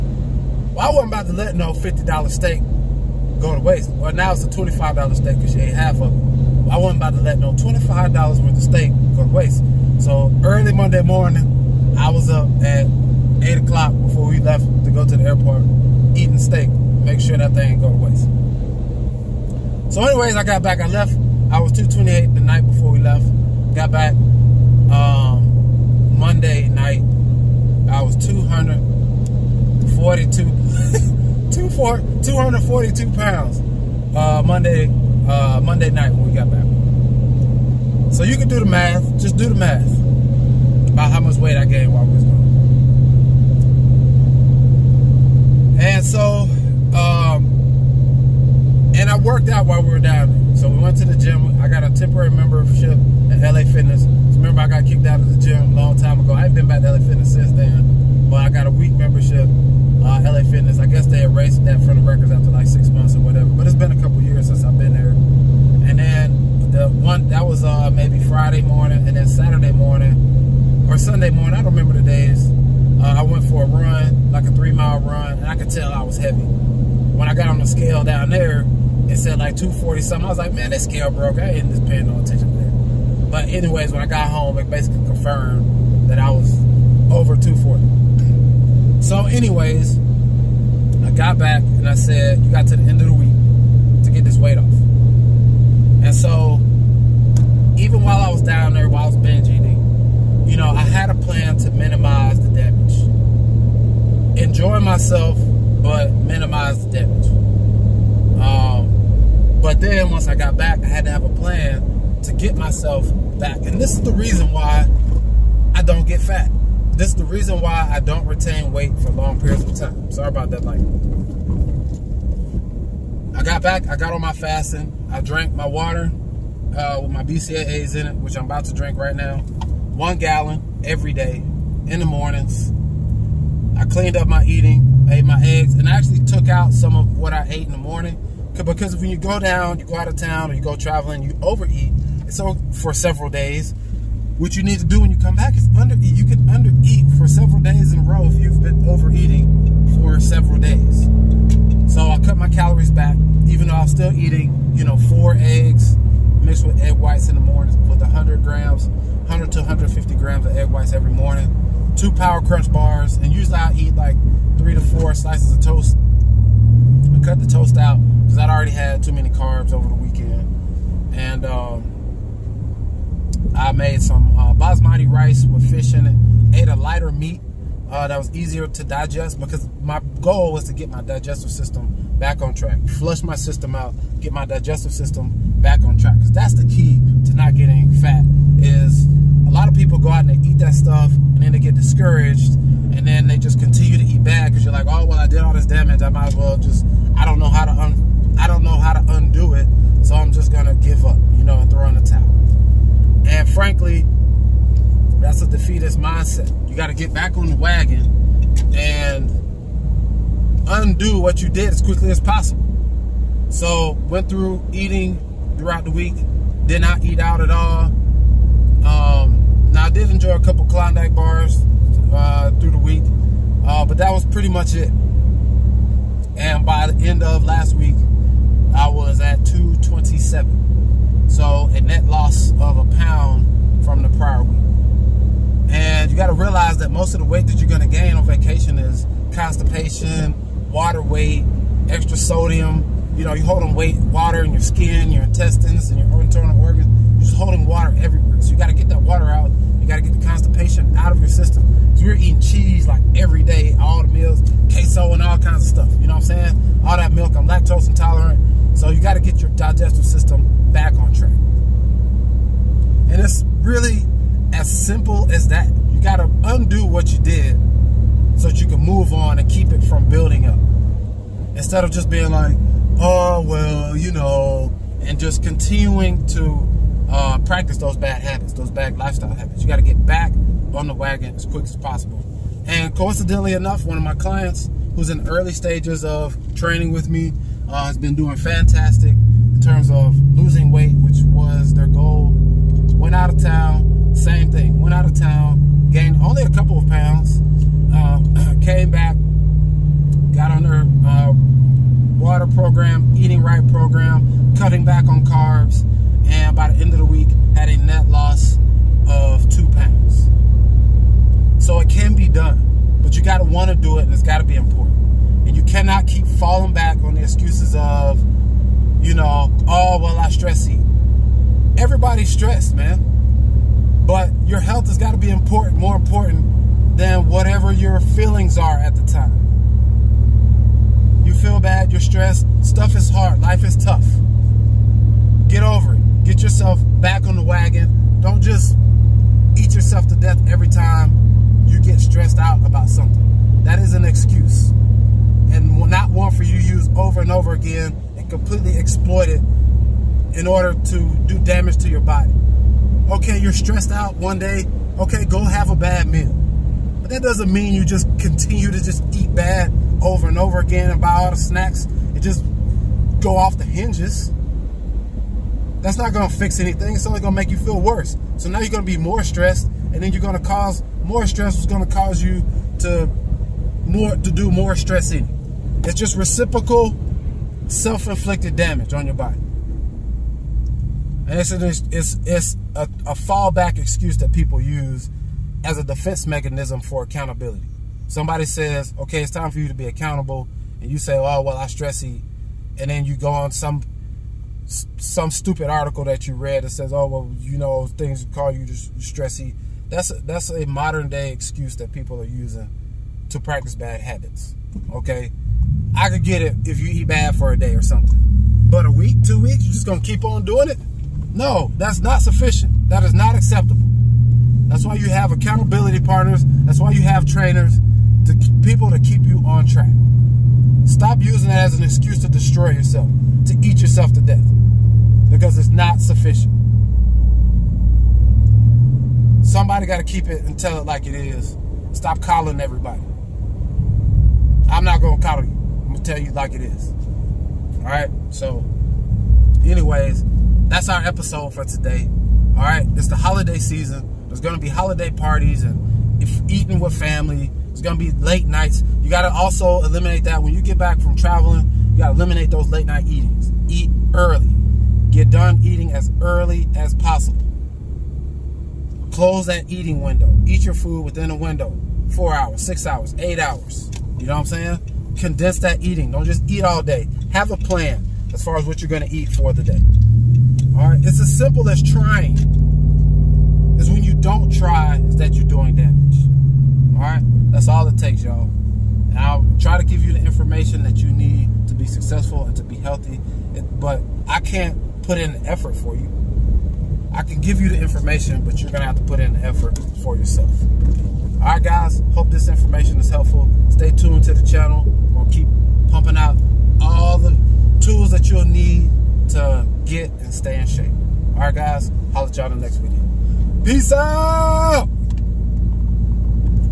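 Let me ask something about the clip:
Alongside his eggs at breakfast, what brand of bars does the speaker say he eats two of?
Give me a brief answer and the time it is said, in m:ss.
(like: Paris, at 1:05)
Power Crunch, at 2:42.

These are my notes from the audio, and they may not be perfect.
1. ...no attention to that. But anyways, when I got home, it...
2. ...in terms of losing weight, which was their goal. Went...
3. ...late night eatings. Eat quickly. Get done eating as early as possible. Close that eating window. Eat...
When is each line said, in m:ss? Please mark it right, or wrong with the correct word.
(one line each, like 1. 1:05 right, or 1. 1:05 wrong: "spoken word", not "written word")
1. 1:22 right
2. 4:49 right
3. 7:32 wrong: "early", not "quickly".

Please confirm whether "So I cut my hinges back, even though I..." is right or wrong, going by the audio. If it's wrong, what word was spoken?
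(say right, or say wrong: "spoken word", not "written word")
wrong: "calories", not "hinges".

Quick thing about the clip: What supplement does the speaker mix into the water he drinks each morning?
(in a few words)
BCAAs.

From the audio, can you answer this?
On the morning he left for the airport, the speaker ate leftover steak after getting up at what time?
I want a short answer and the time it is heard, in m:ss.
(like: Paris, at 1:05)
8 o'clock, at 0:13.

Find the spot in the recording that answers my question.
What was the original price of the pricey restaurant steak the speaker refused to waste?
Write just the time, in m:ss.
0:01.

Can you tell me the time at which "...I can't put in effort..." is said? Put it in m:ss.
8:04.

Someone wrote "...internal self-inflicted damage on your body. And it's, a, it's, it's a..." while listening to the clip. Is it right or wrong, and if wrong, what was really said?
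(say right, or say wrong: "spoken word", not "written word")
wrong: "reciprocal", not "internal".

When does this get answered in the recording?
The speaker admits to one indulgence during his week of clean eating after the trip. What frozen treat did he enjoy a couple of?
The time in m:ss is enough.
3:40.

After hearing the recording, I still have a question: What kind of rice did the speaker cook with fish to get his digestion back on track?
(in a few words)
Basmati.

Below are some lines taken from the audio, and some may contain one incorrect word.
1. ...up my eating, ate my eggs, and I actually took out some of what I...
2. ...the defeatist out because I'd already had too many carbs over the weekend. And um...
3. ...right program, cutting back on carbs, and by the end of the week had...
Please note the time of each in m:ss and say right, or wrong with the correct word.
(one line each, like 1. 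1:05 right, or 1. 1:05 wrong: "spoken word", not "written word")
1. 2:14 right
2. 2:47 wrong: "toast", not "defeatist"
3. 5:03 right.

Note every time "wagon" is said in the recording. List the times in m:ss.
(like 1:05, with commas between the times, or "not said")
3:27, 4:40, 5:37.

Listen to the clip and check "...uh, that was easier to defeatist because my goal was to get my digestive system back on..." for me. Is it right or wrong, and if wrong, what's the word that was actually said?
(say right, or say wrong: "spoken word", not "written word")
wrong: "digest", not "defeatist".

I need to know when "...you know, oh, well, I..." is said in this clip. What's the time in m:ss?
5:19.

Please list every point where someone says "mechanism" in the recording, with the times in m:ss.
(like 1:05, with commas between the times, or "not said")
6:26.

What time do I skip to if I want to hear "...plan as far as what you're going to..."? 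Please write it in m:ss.
7:47.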